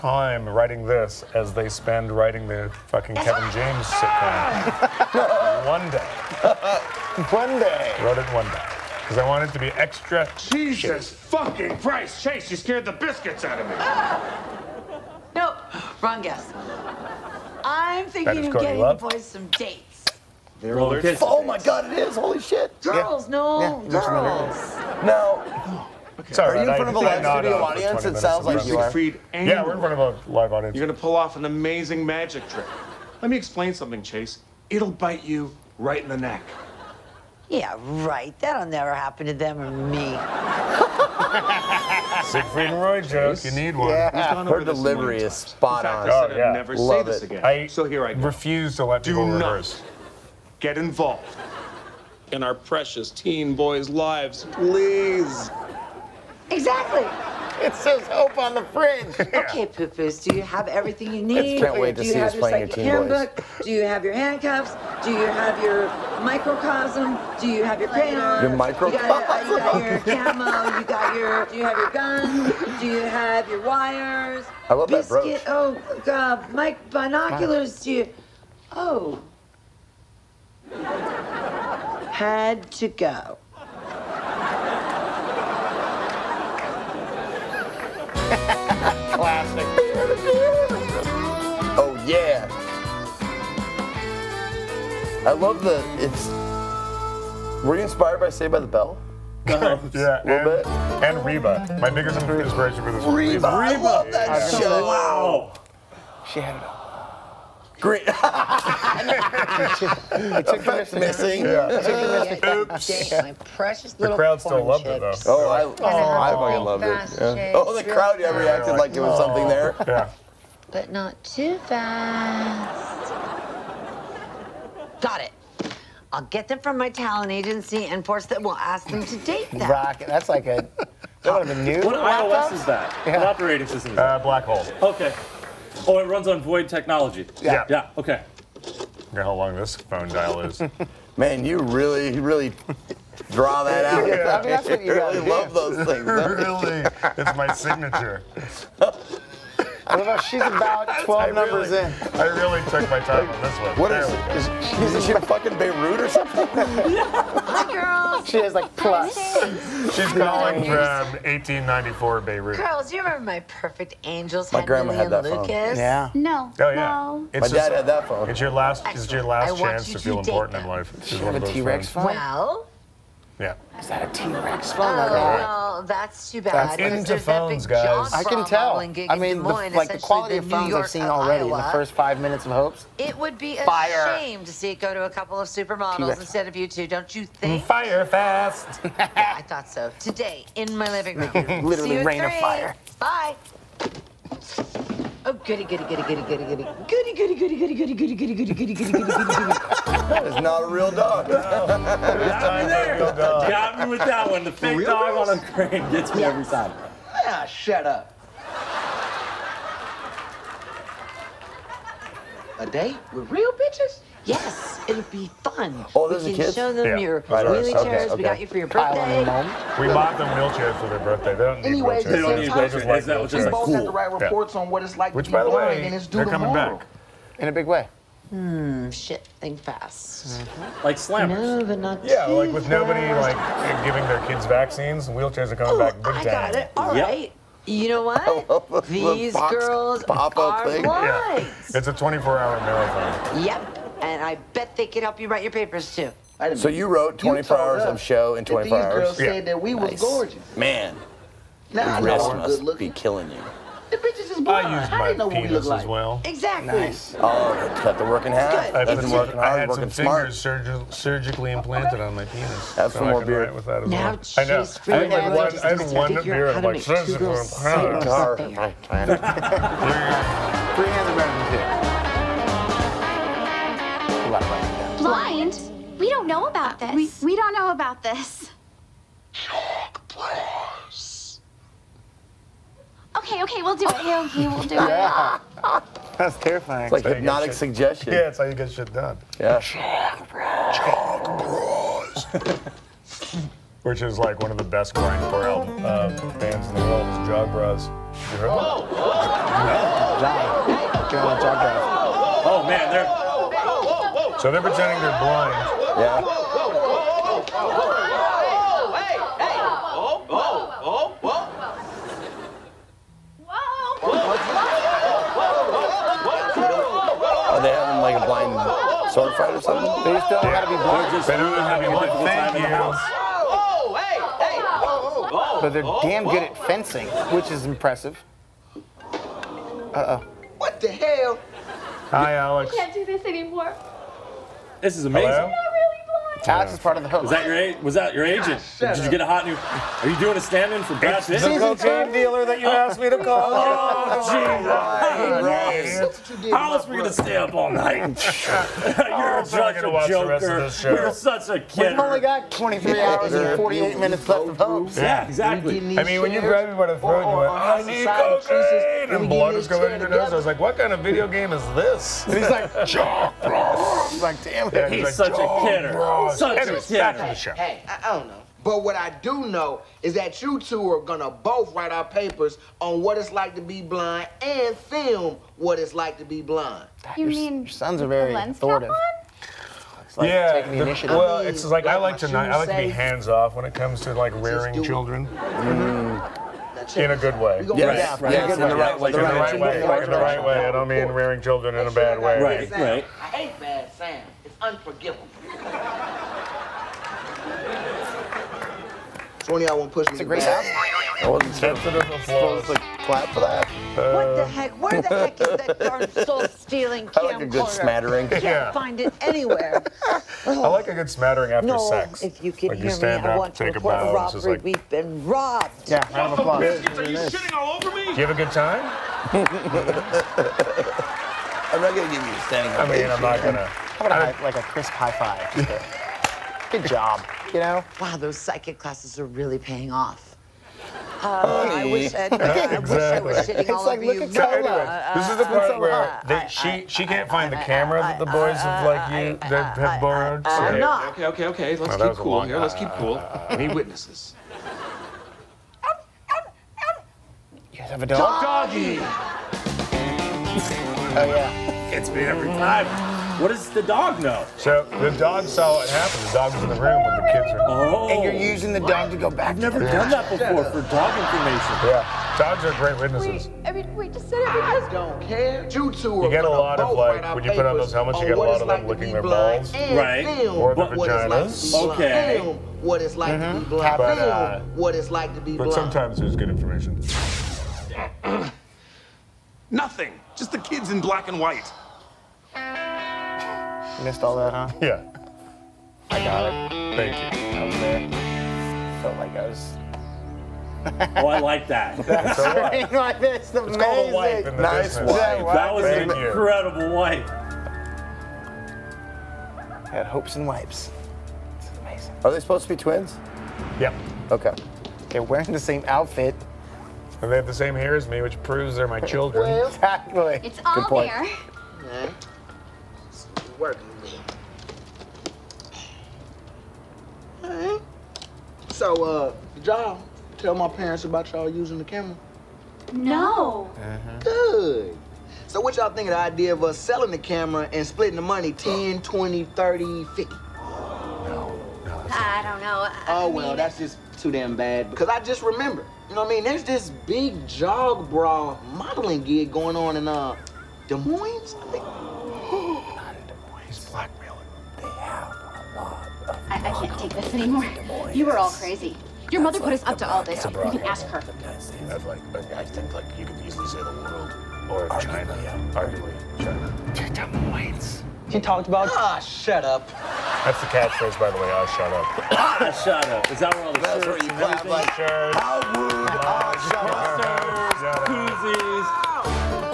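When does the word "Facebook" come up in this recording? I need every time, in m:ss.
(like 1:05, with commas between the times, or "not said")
not said.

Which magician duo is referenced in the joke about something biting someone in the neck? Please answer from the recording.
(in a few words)
Siegfried and Roy.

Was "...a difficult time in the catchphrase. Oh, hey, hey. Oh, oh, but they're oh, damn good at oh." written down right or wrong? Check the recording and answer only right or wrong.
wrong.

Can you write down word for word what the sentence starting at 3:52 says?
nobody like giving their kids vaccines, wheelchairs are coming Ooh, back big I time.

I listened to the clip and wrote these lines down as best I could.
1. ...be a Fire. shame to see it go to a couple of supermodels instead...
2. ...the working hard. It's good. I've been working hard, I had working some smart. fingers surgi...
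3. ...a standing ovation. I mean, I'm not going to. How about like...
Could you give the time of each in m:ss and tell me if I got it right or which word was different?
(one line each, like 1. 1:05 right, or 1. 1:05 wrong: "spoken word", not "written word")
1. 3:03 right
2. 4:17 right
3. 7:02 right.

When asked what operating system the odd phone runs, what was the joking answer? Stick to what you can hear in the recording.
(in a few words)
Black hole.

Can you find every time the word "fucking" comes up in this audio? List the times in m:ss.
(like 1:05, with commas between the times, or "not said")
0:02, 0:11, 1:56, 2:35.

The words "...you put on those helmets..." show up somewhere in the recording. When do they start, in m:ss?
7:47.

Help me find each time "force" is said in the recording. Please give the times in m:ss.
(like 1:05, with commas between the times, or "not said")
2:08.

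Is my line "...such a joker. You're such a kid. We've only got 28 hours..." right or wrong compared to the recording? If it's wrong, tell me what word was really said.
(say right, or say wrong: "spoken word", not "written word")
wrong: "23", not "28".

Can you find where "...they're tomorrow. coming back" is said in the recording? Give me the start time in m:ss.
3:46.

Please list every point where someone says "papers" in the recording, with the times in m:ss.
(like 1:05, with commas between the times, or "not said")
4:05, 6:12.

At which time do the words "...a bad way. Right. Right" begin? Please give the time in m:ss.
6:31.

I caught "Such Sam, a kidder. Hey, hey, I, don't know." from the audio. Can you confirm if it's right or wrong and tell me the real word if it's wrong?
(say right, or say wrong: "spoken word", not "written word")
wrong: "Anyways", not "Sam".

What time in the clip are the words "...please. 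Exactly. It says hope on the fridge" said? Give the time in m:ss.
0:54.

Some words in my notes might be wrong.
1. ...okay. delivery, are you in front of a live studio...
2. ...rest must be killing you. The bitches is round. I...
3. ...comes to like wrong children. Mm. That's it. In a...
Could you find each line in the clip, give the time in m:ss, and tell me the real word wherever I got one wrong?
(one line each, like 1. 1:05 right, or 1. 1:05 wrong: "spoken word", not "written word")
1. 0:26 wrong: "sorry", not "delivery"
2. 4:12 wrong: "blind", not "round"
3. 6:23 wrong: "rearing", not "wrong".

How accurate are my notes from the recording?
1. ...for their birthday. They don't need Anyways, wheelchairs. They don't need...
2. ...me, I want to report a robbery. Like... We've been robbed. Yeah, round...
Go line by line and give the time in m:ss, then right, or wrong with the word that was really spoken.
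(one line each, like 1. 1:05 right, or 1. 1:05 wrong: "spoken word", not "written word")
1. 3:40 right
2. 6:52 right.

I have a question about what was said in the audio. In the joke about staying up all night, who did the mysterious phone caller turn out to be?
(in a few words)
The cocaine dealer.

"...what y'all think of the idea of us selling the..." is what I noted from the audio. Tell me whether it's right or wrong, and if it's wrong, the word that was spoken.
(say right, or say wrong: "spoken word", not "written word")
right.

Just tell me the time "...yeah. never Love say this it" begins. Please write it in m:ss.
0:46.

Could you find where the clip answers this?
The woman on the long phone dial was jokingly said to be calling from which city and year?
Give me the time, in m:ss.
2:41.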